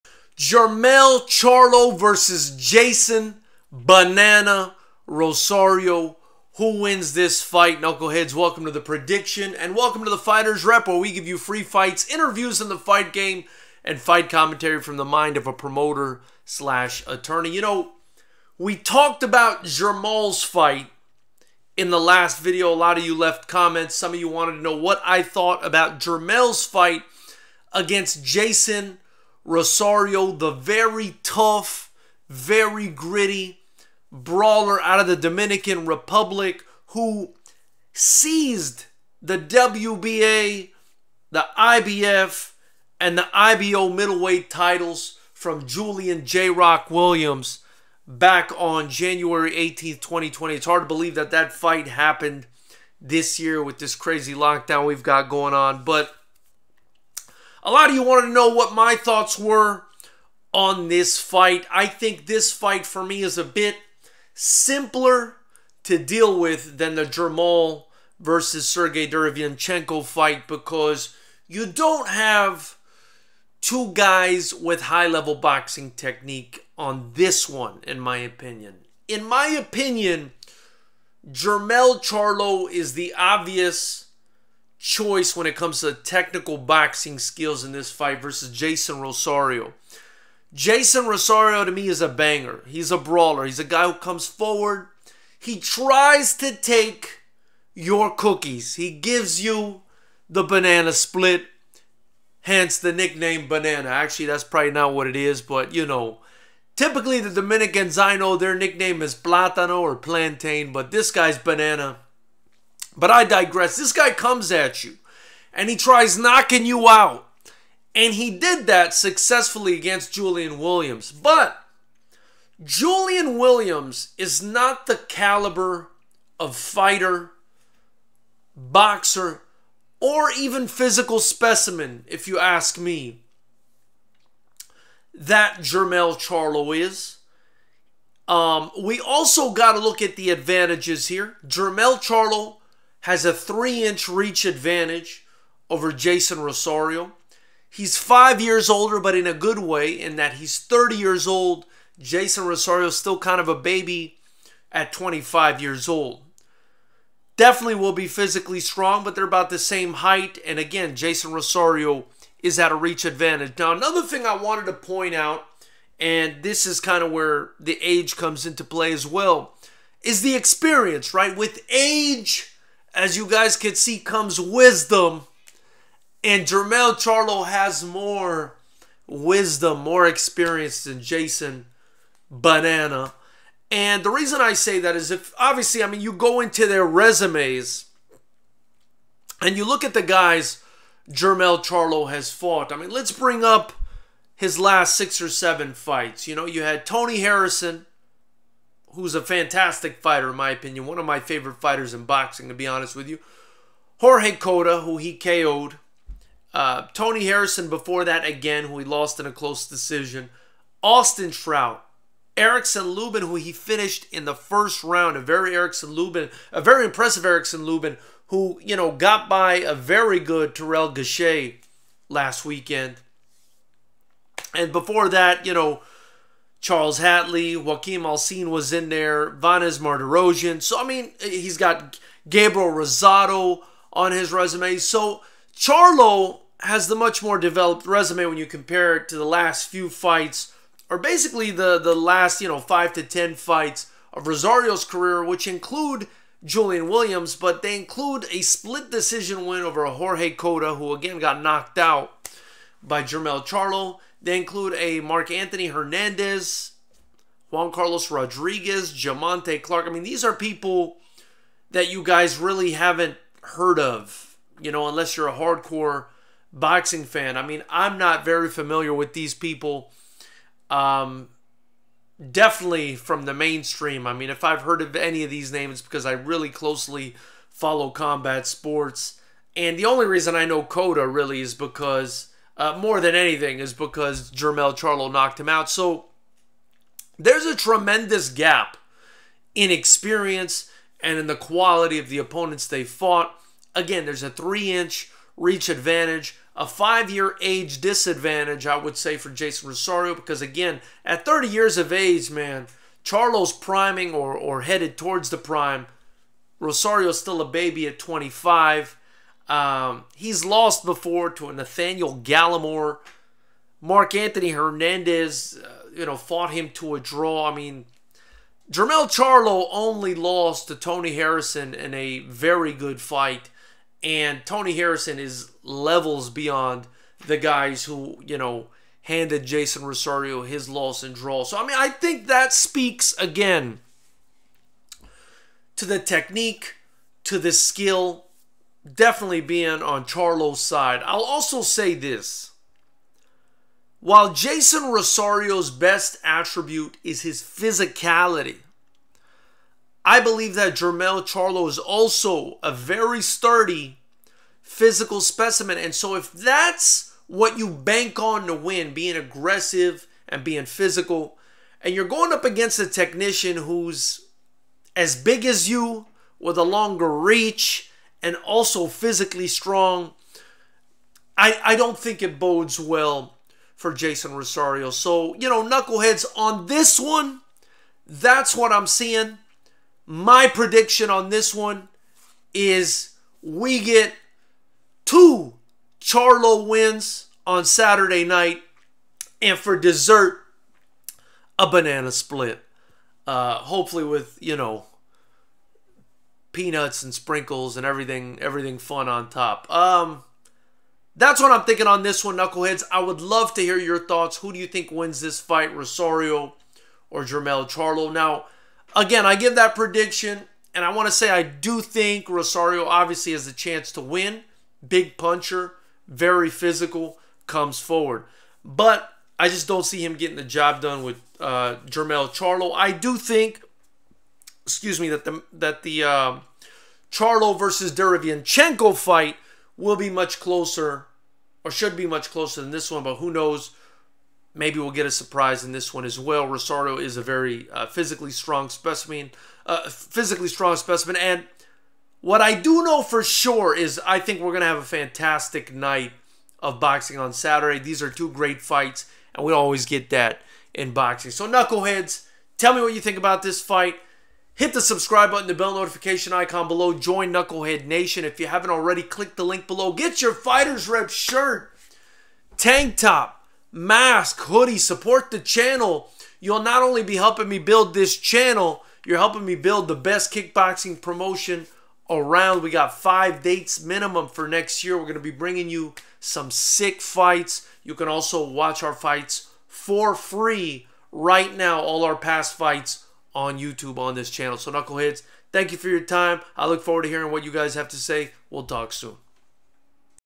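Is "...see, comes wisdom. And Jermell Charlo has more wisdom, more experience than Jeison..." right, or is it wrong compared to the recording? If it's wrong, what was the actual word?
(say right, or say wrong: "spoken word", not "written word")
right.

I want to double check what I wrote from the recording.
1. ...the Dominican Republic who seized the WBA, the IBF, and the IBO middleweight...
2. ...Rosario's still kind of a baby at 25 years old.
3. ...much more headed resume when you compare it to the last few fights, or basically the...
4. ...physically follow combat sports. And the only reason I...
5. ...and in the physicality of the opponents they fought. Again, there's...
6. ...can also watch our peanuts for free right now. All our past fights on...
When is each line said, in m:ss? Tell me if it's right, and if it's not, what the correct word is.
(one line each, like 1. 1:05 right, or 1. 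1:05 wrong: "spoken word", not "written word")
1. 0:35 right
2. 2:32 right
3. 3:56 wrong: "developed", not "headed"
4. 4:36 wrong: "closely", not "physically"
5. 4:51 wrong: "quality", not "physicality"
6. 7:57 wrong: "fights", not "peanuts".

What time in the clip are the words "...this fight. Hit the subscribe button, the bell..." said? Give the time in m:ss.
7:33.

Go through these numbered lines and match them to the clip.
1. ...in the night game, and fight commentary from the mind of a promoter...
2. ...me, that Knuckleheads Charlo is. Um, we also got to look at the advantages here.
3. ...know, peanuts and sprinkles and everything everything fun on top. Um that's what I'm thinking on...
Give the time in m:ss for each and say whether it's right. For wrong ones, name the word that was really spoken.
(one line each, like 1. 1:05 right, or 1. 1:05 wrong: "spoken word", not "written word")
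1. 0:12 wrong: "fight", not "night"
2. 2:12 wrong: "Jermell", not "Knuckleheads"
3. 6:34 right.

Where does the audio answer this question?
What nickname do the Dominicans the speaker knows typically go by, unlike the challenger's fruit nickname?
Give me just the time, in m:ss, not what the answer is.
1:49.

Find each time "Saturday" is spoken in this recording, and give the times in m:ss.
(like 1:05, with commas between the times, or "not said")
6:27, 7:27.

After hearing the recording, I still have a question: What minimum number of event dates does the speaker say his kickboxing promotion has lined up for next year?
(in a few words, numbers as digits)
5.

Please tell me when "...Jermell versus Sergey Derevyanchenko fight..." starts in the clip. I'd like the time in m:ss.
1:07.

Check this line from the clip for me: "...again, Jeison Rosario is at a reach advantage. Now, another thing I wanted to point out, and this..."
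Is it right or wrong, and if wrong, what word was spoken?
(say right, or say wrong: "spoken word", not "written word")
right.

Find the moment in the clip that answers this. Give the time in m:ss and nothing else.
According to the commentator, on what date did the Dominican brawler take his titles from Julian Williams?
0:48.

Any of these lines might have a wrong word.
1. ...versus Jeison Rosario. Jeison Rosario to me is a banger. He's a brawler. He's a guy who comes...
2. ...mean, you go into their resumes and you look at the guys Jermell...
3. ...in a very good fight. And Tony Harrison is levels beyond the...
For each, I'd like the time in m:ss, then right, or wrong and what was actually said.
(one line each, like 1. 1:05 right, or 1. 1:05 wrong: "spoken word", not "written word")
1. 1:28 right
2. 3:05 right
3. 5:21 right.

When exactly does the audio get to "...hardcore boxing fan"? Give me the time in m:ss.
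4:25.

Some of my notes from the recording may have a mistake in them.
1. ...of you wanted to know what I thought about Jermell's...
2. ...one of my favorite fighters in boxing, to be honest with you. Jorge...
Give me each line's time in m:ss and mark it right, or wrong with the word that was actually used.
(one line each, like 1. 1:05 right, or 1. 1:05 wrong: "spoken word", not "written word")
1. 0:24 right
2. 3:20 right.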